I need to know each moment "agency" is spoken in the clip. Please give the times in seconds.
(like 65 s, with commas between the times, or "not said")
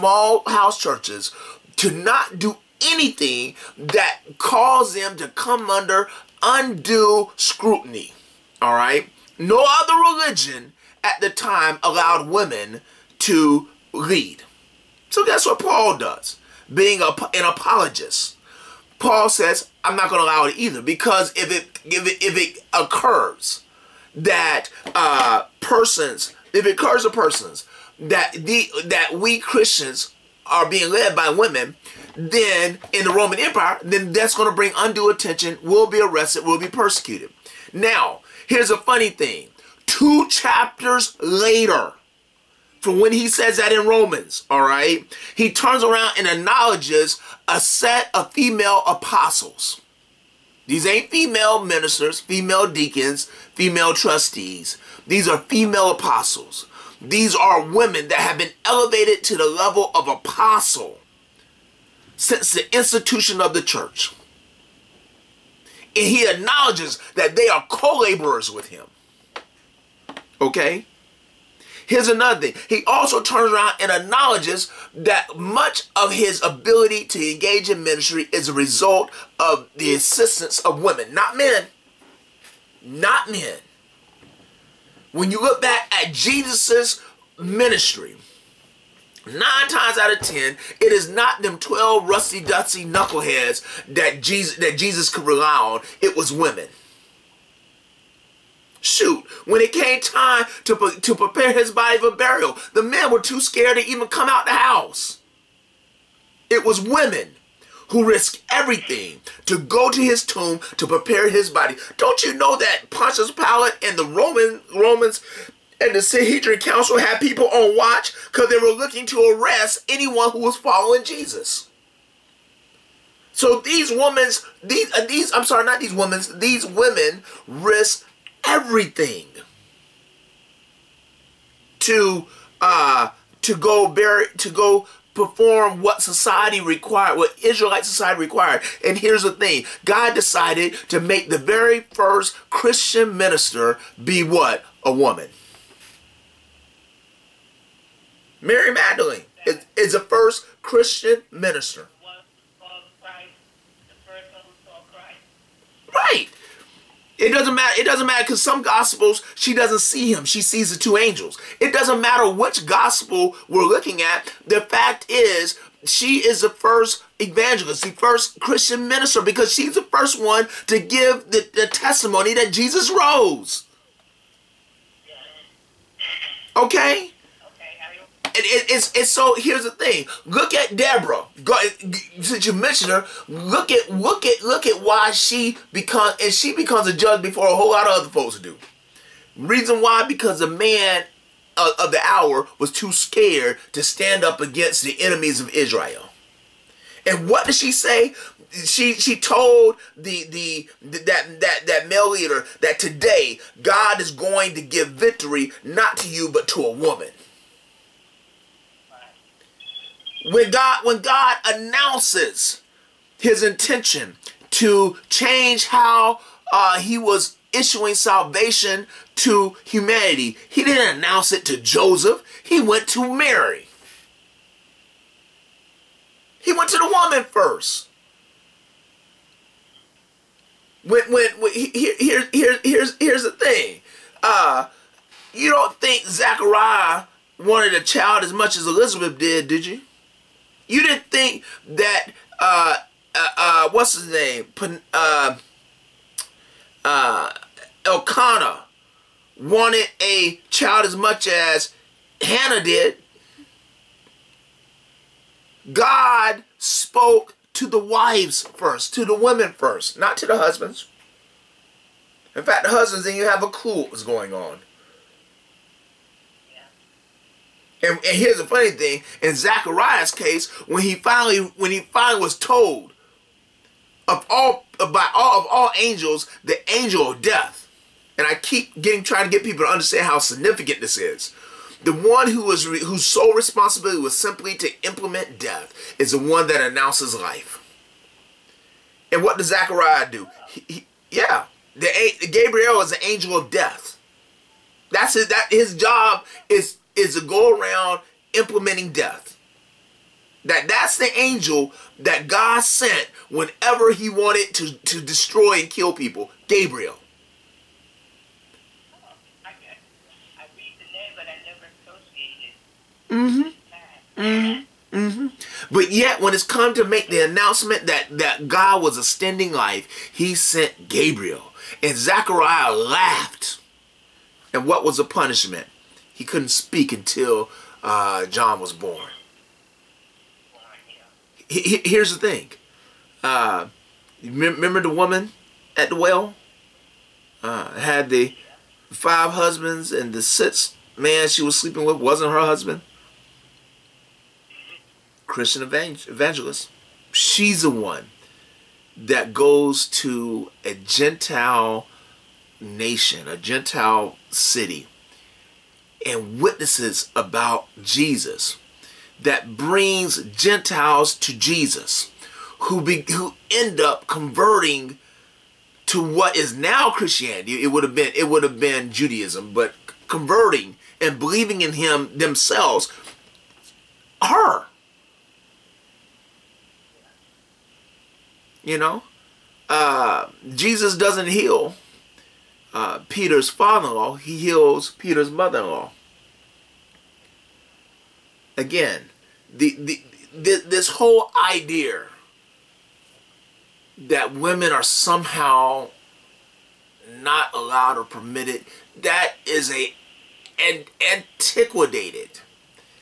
not said.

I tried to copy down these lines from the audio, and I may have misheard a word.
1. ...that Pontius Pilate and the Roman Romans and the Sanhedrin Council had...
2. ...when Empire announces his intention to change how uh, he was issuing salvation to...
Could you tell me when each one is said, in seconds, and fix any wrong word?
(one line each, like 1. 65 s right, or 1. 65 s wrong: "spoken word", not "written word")
1. 112 s right
2. 210 s wrong: "God", not "Empire".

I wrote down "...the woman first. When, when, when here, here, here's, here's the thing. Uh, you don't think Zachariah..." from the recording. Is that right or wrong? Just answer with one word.
right.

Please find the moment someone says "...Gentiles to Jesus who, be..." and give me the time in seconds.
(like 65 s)
360 s.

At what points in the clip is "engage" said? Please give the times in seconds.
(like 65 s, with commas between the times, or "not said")
77 s.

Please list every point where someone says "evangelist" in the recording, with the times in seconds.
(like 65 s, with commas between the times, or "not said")
167 s, 345 s.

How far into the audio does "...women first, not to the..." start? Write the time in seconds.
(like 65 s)
259 s.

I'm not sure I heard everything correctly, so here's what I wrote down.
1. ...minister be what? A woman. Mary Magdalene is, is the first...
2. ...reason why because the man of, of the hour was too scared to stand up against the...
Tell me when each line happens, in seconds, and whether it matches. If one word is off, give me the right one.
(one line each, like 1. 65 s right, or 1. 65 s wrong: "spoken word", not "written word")
1. 143 s right
2. 189 s right.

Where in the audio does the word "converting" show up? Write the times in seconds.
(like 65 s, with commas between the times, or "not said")
364 s, 370 s.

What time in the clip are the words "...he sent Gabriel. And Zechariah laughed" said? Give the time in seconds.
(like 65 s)
320 s.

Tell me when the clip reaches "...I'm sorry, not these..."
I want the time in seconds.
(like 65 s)
125 s.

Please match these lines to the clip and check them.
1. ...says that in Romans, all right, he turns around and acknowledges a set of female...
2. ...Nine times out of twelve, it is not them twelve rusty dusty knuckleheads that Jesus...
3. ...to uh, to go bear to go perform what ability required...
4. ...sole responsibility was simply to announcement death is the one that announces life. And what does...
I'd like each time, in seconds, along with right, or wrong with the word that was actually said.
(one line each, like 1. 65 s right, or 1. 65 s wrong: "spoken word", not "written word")
1. 43 s right
2. 89 s wrong: "ten", not "twelve"
3. 131 s wrong: "society", not "ability"
4. 283 s wrong: "implement", not "announcement".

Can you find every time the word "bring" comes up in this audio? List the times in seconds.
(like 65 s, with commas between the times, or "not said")
34 s, 359 s.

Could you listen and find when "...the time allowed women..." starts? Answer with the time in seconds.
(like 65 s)
11 s.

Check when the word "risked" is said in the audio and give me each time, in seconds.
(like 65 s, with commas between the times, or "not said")
108 s, 127 s.